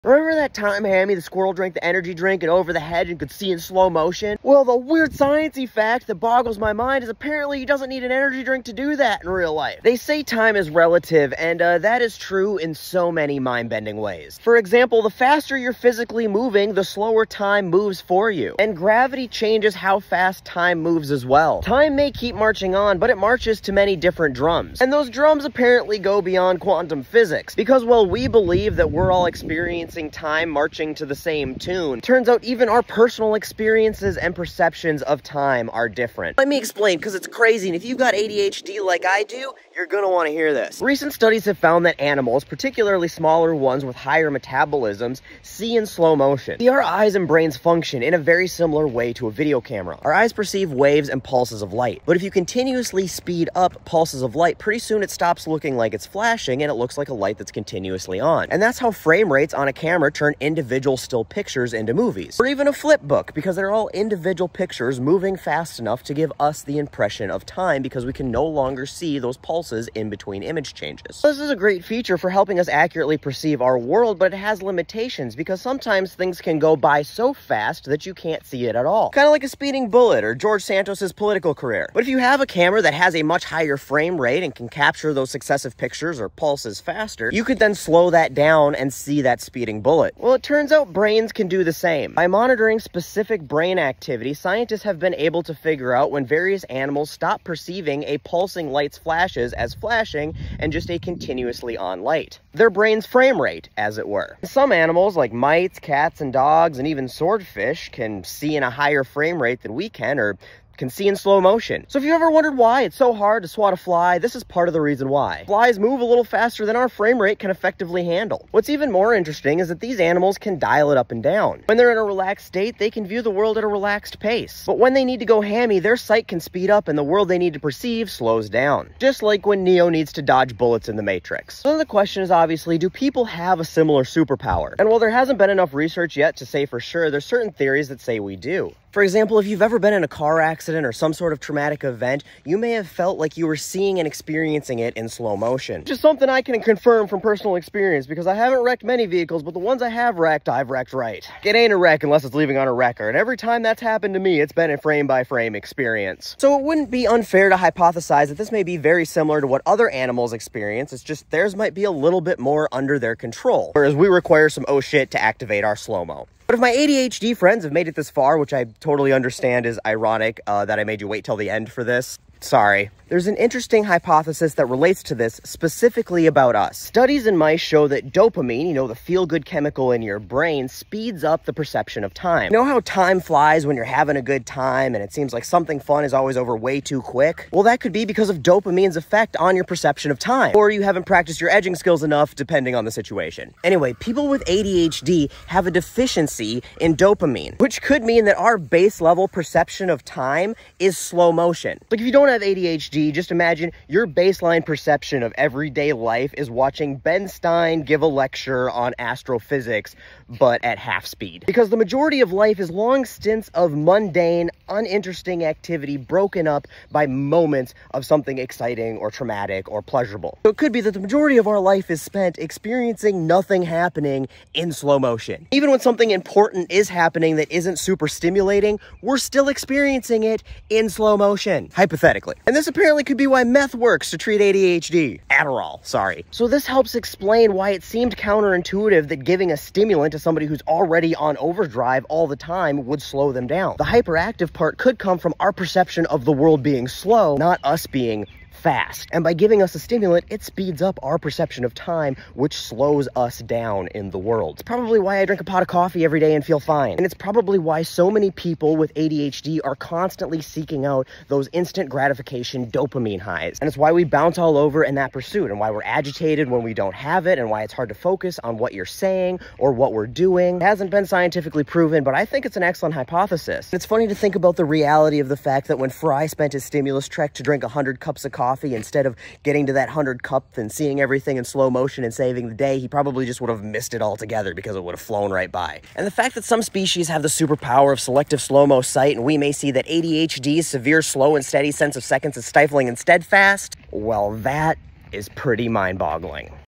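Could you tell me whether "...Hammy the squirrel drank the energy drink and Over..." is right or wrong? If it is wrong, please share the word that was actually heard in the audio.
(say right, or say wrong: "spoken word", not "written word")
right.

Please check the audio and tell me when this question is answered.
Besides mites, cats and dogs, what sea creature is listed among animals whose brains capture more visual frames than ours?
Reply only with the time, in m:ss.
1:47.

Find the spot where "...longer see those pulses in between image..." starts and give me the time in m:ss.
1:08.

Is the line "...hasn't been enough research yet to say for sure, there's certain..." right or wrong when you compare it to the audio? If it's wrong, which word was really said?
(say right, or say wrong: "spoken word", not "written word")
right.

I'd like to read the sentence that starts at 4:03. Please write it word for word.
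The hyperactive part could come from our perception of the world being slow, not us being fast.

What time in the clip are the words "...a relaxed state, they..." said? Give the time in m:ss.
2:01.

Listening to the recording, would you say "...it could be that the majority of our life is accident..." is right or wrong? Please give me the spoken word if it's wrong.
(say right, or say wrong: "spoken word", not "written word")
wrong: "spent", not "accident".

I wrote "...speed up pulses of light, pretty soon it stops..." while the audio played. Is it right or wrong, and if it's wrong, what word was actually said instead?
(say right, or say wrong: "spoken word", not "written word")
right.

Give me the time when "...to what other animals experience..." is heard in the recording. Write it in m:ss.
2:39.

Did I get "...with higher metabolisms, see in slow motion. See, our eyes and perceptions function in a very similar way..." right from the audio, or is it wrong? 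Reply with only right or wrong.
wrong.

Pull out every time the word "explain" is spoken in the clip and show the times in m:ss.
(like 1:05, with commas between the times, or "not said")
0:36, 3:56.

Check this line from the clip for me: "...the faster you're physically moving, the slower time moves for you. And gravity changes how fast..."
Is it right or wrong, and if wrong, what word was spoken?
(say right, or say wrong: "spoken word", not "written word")
right.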